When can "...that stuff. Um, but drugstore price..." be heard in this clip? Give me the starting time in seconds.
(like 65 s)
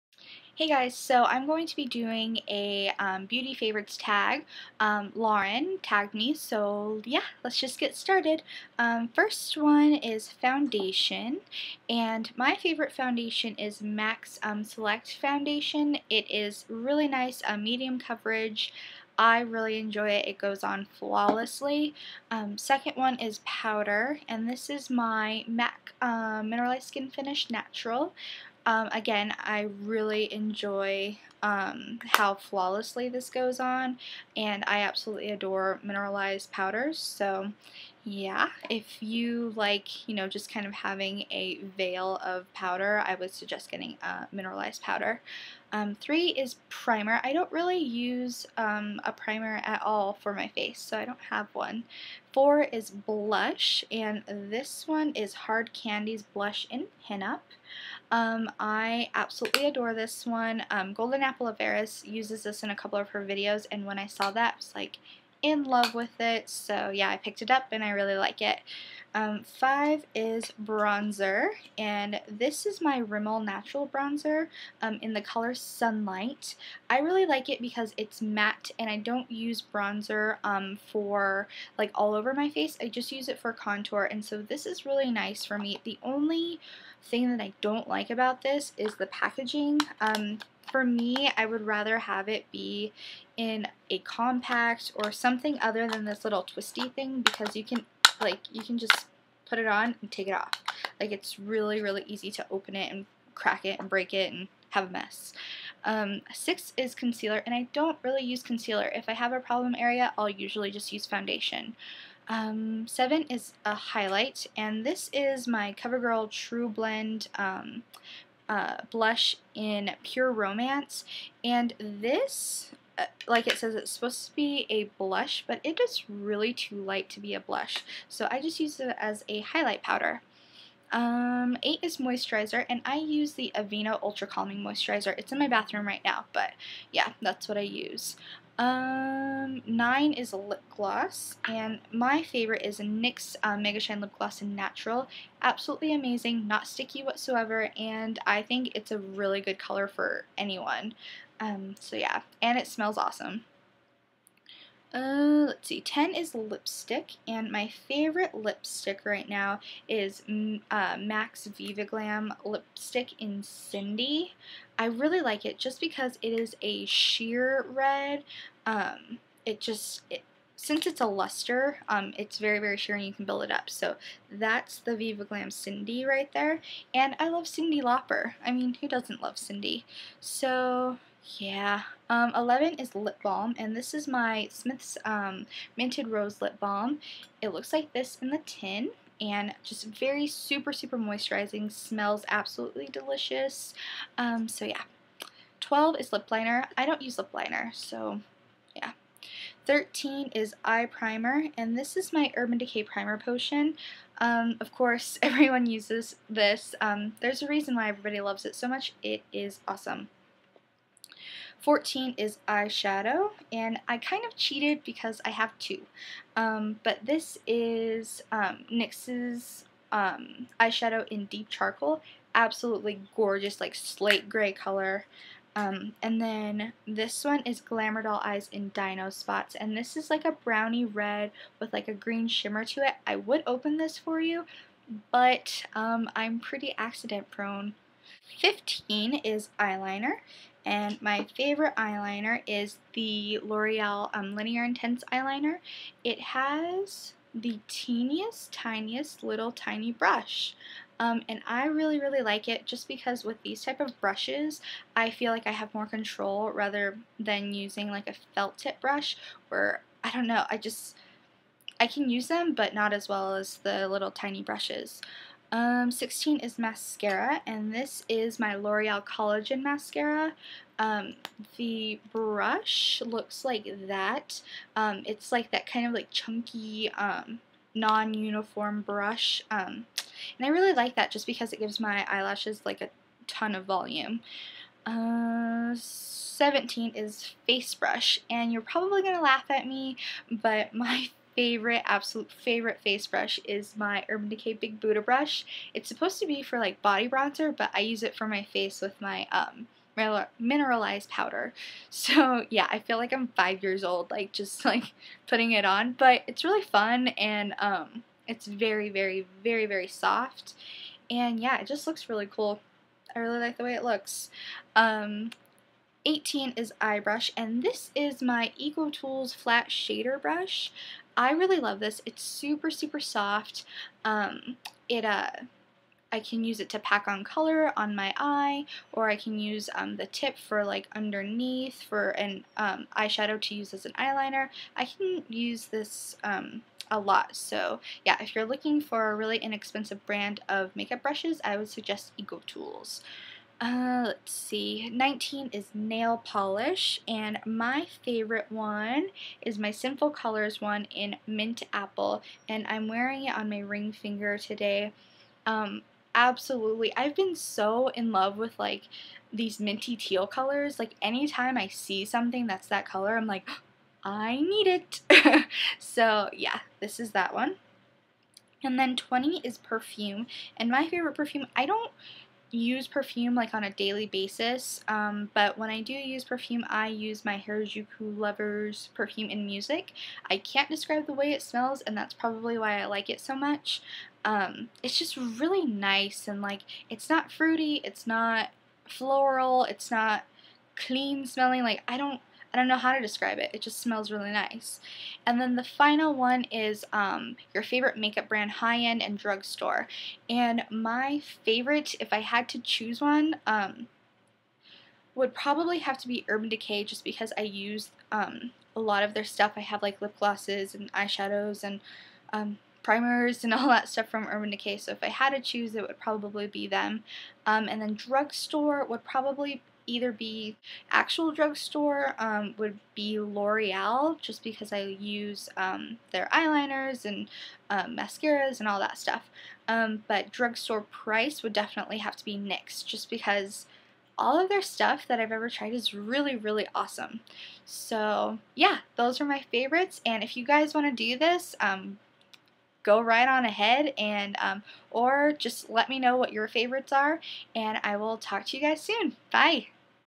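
428 s.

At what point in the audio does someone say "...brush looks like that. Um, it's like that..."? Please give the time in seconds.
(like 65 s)
272 s.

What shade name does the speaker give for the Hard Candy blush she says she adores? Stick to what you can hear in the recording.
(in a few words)
Pinup.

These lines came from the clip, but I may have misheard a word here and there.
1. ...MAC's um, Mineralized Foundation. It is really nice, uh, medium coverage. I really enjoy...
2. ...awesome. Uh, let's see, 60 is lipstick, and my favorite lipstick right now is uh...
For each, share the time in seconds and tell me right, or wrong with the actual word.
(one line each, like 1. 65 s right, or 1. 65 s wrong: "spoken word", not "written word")
1. 13 s wrong: "Select", not "Mineralized"
2. 152 s wrong: "10", not "60".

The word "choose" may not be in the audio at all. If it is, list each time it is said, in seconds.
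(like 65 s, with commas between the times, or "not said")
402 s, 415 s.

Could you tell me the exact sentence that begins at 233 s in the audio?
I would open this for you, but um, I'm pretty accident prone.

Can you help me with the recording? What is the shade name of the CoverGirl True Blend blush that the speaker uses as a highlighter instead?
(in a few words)
Pure Romance.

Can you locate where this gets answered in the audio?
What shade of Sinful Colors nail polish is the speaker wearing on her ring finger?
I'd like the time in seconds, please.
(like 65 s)
351 s.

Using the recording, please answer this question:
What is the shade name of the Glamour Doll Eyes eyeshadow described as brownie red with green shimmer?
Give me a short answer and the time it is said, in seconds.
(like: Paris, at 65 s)
Dino Spots, at 228 s.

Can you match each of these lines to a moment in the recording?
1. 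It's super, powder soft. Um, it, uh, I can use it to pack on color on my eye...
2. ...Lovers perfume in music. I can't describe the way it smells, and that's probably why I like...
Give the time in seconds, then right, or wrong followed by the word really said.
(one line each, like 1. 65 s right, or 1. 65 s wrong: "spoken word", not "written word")
1. 322 s wrong: "super", not "powder"
2. 378 s right.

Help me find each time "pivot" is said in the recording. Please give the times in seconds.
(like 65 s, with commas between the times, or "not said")
not said.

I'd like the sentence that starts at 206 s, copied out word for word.
Um, there's a reason why everybody loves it so much.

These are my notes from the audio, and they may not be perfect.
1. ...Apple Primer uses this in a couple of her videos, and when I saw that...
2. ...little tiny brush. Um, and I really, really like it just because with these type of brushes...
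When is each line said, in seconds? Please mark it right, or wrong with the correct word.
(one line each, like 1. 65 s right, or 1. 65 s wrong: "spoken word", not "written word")
1. 61 s wrong: "Averis", not "Primer"
2. 249 s right.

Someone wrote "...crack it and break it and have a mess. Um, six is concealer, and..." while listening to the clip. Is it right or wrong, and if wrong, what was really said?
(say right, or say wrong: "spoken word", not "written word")
right.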